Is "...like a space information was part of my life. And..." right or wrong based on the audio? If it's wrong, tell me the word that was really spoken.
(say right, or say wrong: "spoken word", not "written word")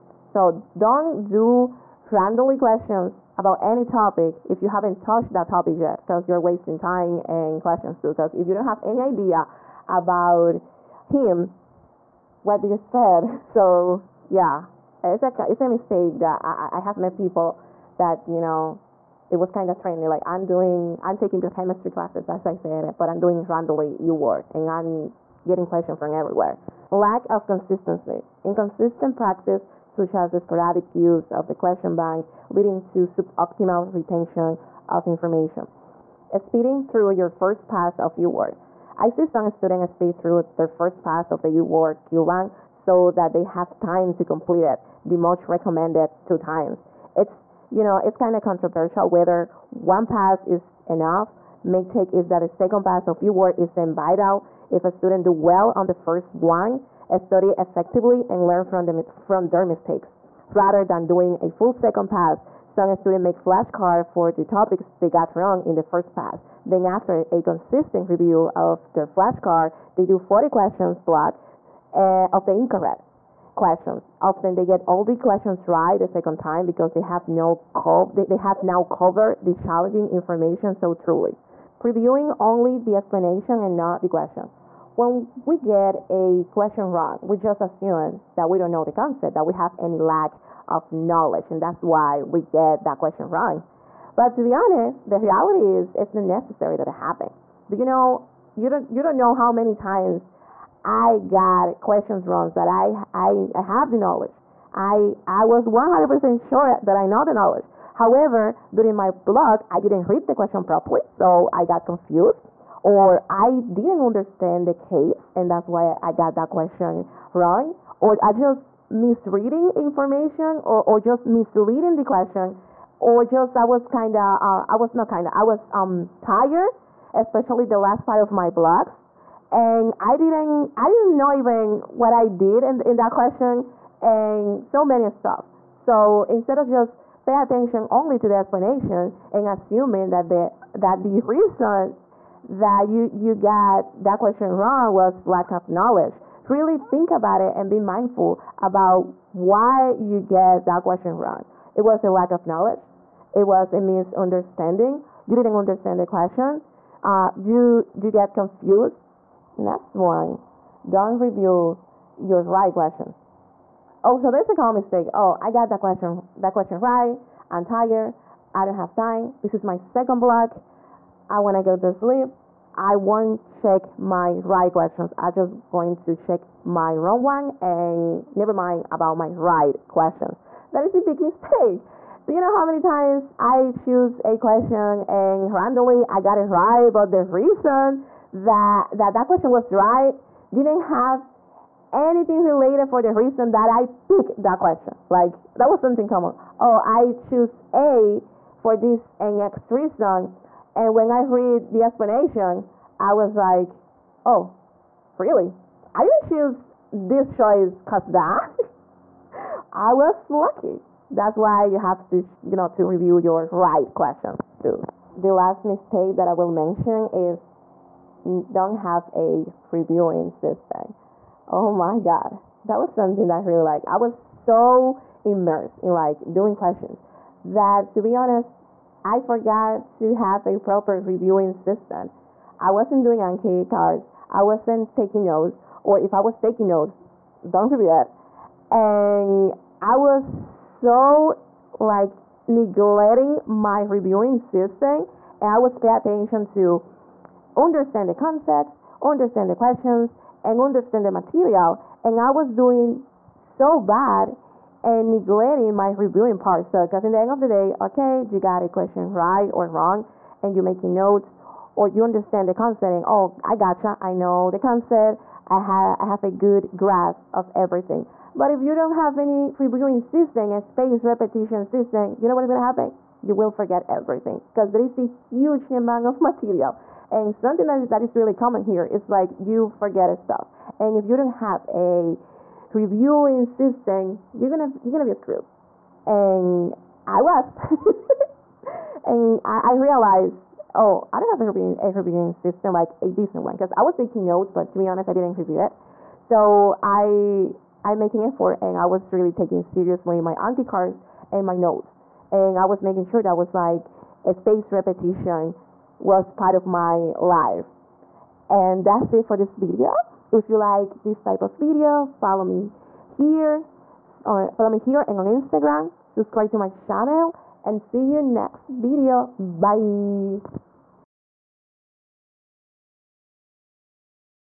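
wrong: "repetition", not "information".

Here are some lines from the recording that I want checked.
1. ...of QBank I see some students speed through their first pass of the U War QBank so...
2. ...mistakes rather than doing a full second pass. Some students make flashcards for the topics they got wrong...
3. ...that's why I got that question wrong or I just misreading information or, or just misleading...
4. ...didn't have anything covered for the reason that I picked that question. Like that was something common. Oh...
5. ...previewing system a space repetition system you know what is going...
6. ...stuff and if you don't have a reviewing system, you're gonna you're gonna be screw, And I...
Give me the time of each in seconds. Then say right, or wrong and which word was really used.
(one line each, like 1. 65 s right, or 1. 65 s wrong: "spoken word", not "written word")
1. 37 s wrong: "UWorld", not "QBank"
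2. 59 s right
3. 115 s right
4. 190 s wrong: "related", not "covered"
5. 269 s right
6. 280 s right.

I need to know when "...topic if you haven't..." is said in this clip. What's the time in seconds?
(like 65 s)
3 s.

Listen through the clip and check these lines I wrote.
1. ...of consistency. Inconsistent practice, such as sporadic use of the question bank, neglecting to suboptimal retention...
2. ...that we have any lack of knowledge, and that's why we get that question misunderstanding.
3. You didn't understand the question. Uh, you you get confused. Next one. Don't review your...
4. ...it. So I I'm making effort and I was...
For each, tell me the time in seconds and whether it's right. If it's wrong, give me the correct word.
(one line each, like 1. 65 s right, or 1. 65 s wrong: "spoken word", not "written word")
1. 27 s wrong: "leading", not "neglecting"
2. 89 s wrong: "wrong", not "misunderstanding"
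3. 155 s right
4. 295 s right.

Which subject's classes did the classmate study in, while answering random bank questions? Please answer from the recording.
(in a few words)
biochemistry.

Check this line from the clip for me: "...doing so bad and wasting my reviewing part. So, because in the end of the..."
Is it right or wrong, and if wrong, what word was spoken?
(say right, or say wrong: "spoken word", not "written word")
wrong: "neglecting", not "wasting".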